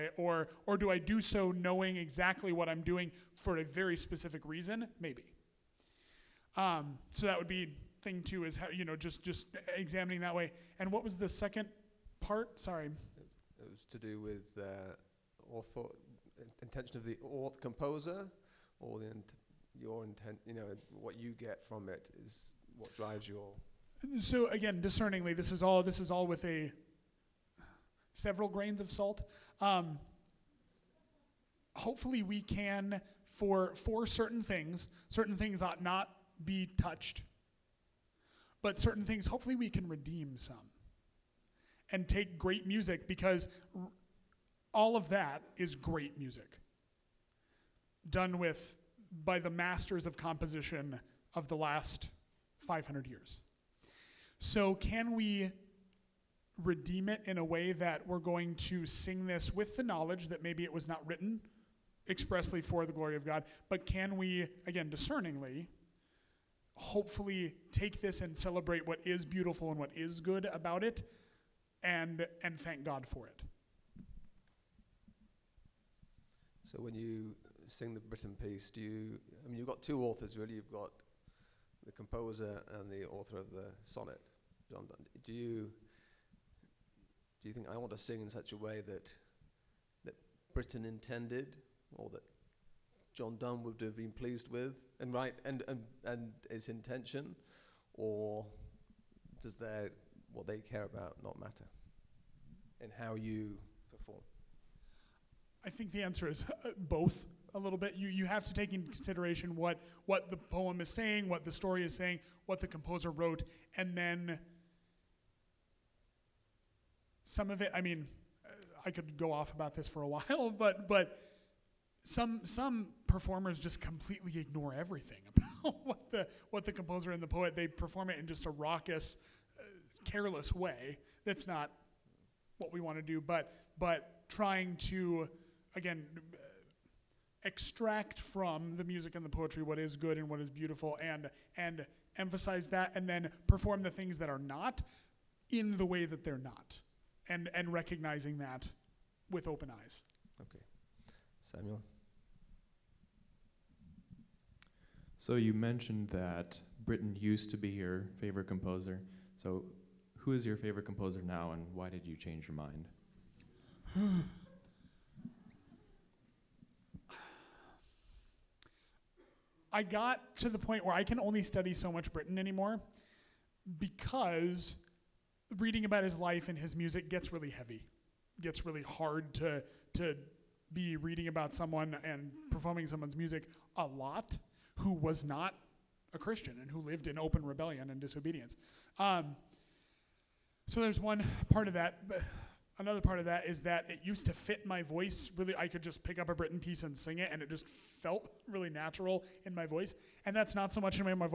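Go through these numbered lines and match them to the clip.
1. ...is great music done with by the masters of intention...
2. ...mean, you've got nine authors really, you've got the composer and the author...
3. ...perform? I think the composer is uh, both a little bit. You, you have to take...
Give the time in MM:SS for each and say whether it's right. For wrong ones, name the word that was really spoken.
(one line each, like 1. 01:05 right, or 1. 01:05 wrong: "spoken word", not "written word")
1. 00:45 wrong: "composition", not "intention"
2. 01:19 wrong: "two", not "nine"
3. 01:43 wrong: "answer", not "composer".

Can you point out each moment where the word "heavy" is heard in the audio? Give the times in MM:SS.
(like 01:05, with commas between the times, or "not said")
02:57.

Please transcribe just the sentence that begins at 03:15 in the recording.
I could just pick up a Britten piece and sing it, and it just felt really natural in my voice.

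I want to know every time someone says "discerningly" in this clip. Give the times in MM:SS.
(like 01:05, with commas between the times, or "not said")
00:24, 01:04.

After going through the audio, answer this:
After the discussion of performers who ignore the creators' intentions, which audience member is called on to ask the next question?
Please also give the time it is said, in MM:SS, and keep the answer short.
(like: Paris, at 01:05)
Samuel, at 02:31.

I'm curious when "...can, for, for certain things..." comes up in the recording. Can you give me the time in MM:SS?
00:32.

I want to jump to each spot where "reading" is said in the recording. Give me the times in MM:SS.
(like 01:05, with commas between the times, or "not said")
02:55, 03:00.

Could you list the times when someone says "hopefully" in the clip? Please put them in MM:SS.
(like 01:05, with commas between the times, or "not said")
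00:31, 00:39, 01:06.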